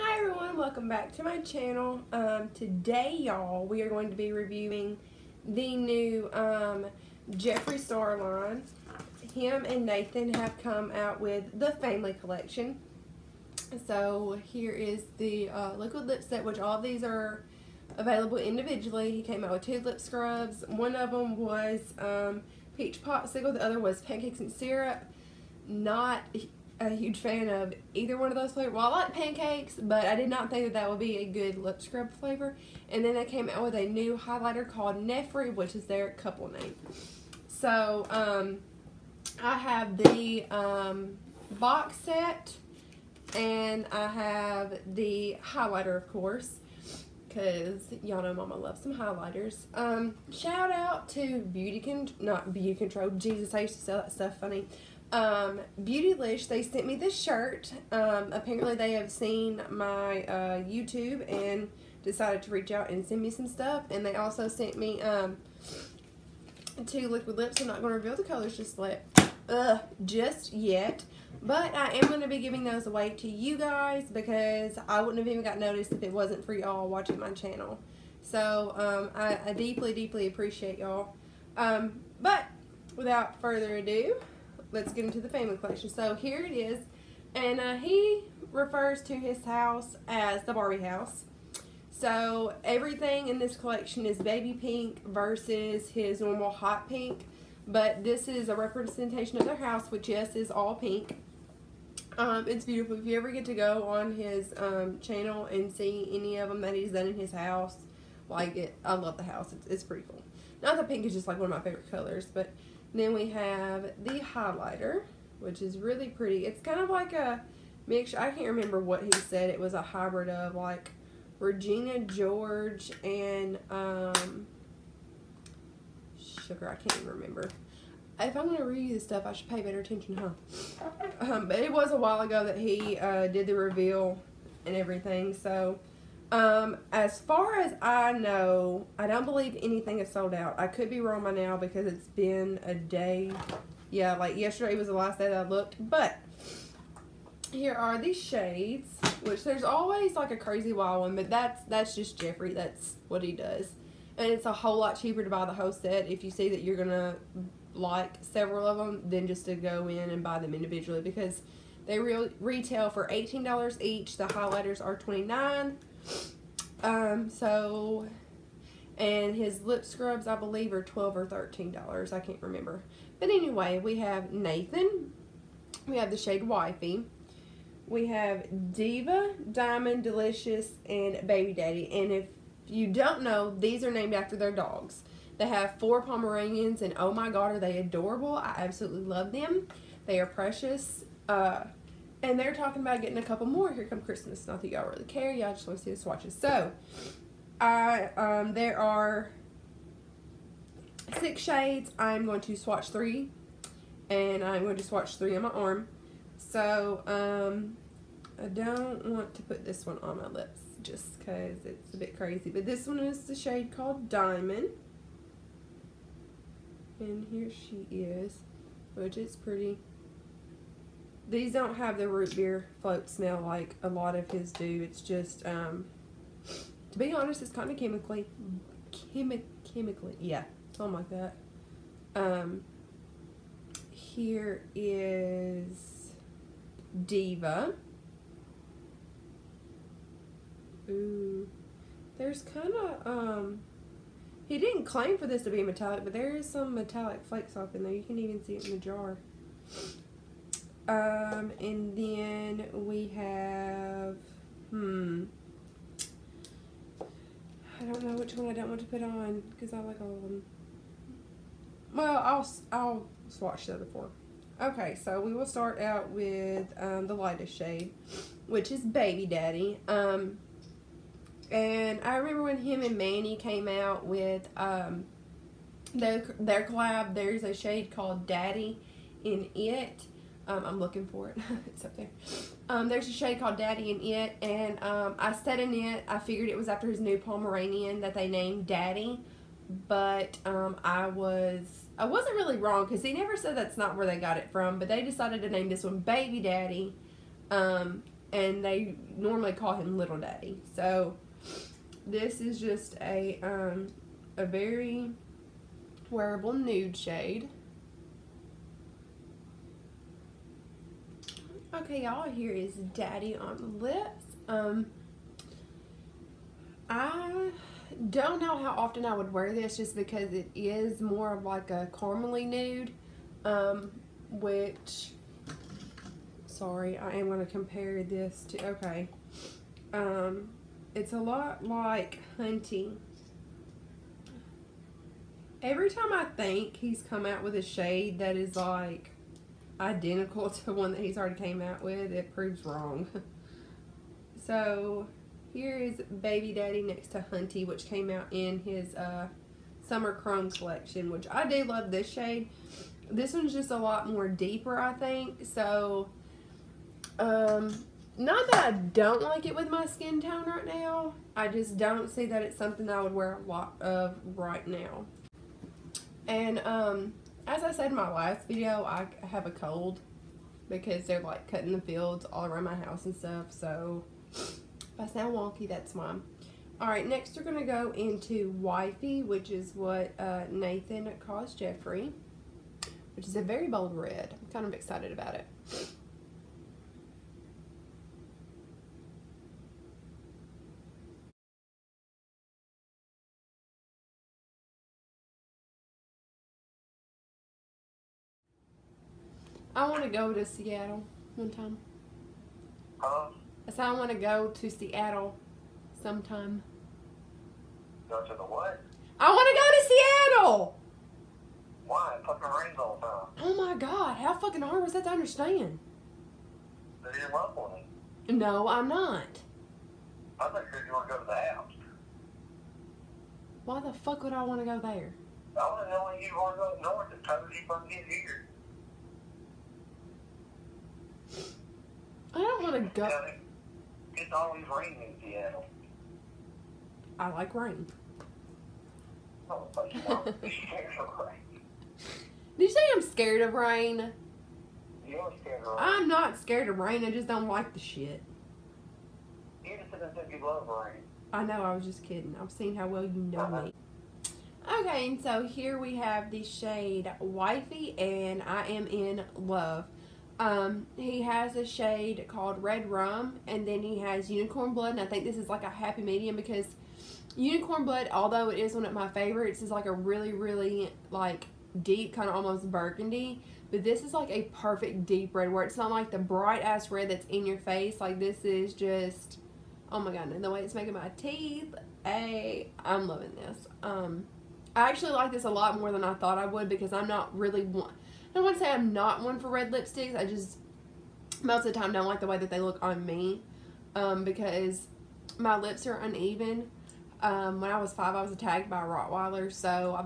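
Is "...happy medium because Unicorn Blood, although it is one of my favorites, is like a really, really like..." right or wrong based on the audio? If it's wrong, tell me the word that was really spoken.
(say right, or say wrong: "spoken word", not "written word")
right.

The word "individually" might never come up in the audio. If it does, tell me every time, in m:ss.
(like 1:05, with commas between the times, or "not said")
0:18, 2:40.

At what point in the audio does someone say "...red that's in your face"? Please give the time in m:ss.
7:56.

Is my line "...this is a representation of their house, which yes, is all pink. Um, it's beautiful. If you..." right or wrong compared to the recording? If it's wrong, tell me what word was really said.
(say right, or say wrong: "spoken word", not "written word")
right.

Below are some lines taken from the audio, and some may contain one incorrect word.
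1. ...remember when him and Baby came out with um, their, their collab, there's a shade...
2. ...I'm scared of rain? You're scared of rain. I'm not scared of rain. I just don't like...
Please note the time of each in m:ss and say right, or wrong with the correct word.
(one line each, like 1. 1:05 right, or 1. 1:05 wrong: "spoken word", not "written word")
1. 4:32 wrong: "Manny", not "Baby"
2. 7:22 right.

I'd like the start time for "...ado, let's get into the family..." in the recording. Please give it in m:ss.
1:23.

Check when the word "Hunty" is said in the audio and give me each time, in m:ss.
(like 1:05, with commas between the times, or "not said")
5:32, 5:47.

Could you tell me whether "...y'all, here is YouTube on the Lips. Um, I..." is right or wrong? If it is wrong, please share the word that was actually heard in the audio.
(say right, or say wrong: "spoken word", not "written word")
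wrong: "Daddy", not "YouTube".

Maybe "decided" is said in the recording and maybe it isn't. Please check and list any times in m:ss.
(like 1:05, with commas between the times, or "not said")
1:02, 4:55.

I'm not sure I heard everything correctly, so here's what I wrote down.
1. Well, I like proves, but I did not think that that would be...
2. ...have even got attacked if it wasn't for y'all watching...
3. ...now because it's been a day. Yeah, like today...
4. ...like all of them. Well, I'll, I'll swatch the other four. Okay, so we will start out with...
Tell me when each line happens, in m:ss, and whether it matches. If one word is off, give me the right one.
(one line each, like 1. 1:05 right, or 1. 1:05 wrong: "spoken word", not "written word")
1. 0:28 wrong: "pancakes", not "proves"
2. 1:15 wrong: "noticed", not "attacked"
3. 2:21 wrong: "yesterday", not "today"
4. 4:19 right.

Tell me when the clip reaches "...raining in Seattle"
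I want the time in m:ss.
7:14.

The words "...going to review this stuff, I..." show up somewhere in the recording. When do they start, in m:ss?
2:08.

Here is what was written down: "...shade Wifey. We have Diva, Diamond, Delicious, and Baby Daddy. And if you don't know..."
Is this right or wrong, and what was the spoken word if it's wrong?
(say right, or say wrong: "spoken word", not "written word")
right.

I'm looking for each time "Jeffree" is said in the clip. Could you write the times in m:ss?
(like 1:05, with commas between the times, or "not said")
0:07, 2:32, 6:21.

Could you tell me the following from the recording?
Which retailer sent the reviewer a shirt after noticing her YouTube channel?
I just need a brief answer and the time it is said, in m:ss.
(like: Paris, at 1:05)
Beautylish, at 0:55.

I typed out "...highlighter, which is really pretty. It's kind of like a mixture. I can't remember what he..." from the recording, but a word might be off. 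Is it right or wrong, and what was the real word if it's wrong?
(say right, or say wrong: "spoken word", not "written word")
right.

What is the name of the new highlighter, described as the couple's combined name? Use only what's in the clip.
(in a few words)
Nefri.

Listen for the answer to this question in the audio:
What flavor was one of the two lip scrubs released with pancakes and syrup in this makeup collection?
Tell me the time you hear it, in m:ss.
0:22.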